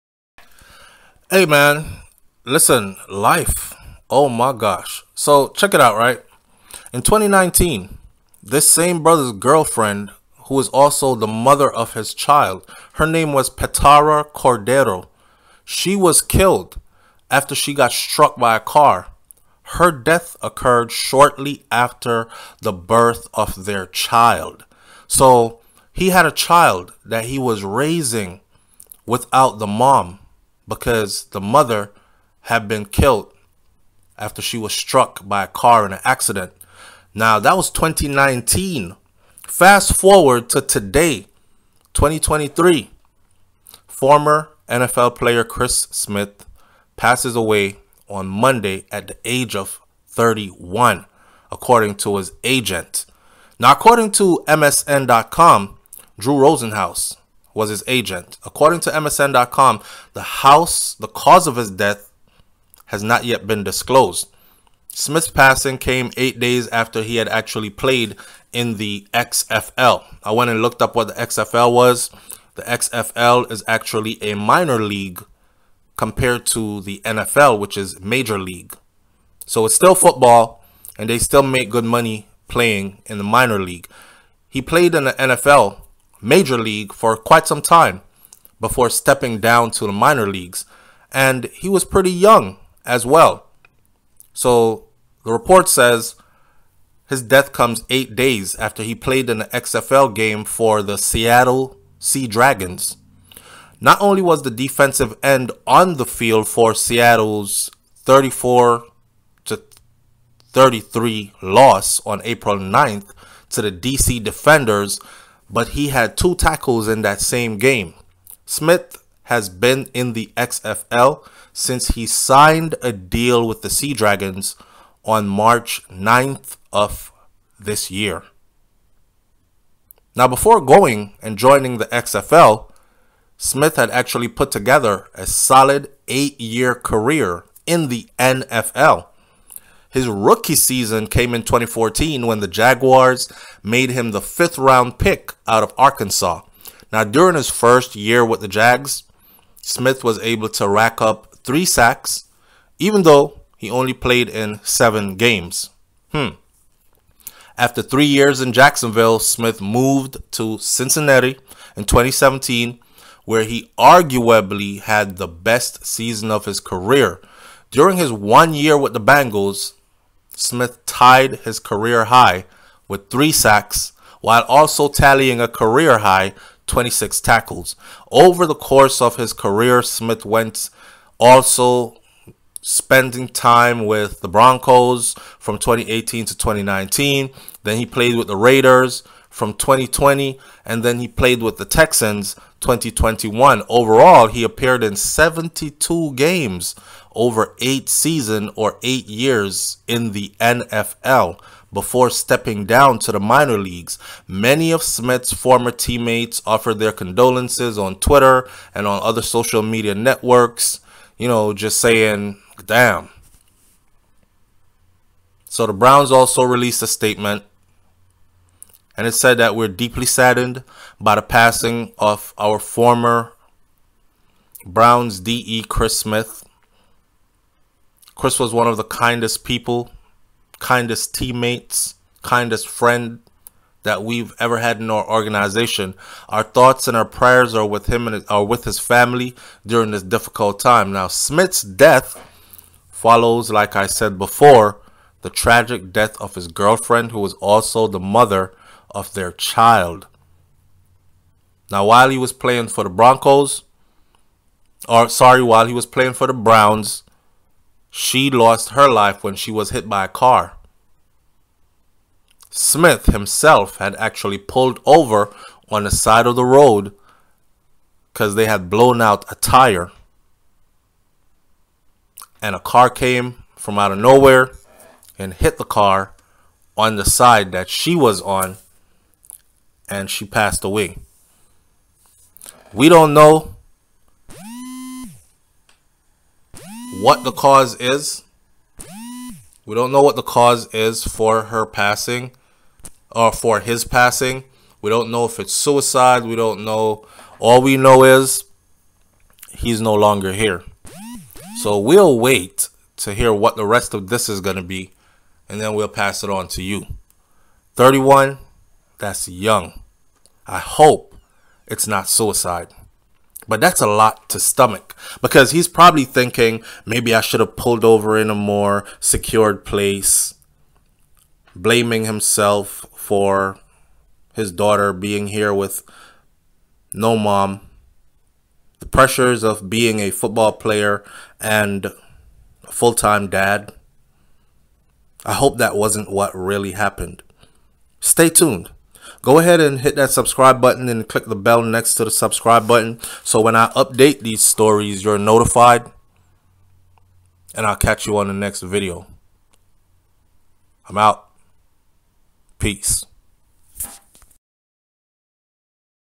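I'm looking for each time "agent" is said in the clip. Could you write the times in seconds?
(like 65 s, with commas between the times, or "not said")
52 s, 57 s.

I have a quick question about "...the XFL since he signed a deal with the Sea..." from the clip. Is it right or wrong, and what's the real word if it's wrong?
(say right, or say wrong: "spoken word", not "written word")
right.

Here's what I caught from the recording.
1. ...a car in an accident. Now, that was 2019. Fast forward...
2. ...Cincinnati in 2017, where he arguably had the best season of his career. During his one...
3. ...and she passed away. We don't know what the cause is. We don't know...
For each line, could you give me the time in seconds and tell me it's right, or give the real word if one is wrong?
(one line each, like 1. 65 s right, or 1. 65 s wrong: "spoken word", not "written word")
1. 35 s right
2. 160 s right
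3. 279 s right.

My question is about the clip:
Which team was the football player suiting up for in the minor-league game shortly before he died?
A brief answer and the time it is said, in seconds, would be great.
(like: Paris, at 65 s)
Seattle Sea Dragons, at 100 s.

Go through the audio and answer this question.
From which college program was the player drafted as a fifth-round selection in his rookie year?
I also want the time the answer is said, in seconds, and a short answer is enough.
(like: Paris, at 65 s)
Arkansas, at 145 s.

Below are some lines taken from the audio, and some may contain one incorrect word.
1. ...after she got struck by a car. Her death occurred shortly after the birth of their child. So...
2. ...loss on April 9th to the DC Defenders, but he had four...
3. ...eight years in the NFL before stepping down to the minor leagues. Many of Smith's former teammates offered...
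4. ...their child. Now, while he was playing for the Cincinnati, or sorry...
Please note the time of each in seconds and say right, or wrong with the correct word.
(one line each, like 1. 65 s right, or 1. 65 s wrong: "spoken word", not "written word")
1. 17 s right
2. 111 s wrong: "two", not "four"
3. 198 s right
4. 249 s wrong: "Broncos", not "Cincinnati".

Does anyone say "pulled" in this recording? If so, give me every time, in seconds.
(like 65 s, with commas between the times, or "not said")
264 s, 317 s.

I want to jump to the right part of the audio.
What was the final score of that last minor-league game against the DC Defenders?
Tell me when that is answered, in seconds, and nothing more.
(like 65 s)
107 s.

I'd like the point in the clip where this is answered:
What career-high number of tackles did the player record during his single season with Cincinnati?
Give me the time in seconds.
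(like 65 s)
176 s.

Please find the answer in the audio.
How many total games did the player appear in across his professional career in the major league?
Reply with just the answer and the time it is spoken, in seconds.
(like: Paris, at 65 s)
72, at 194 s.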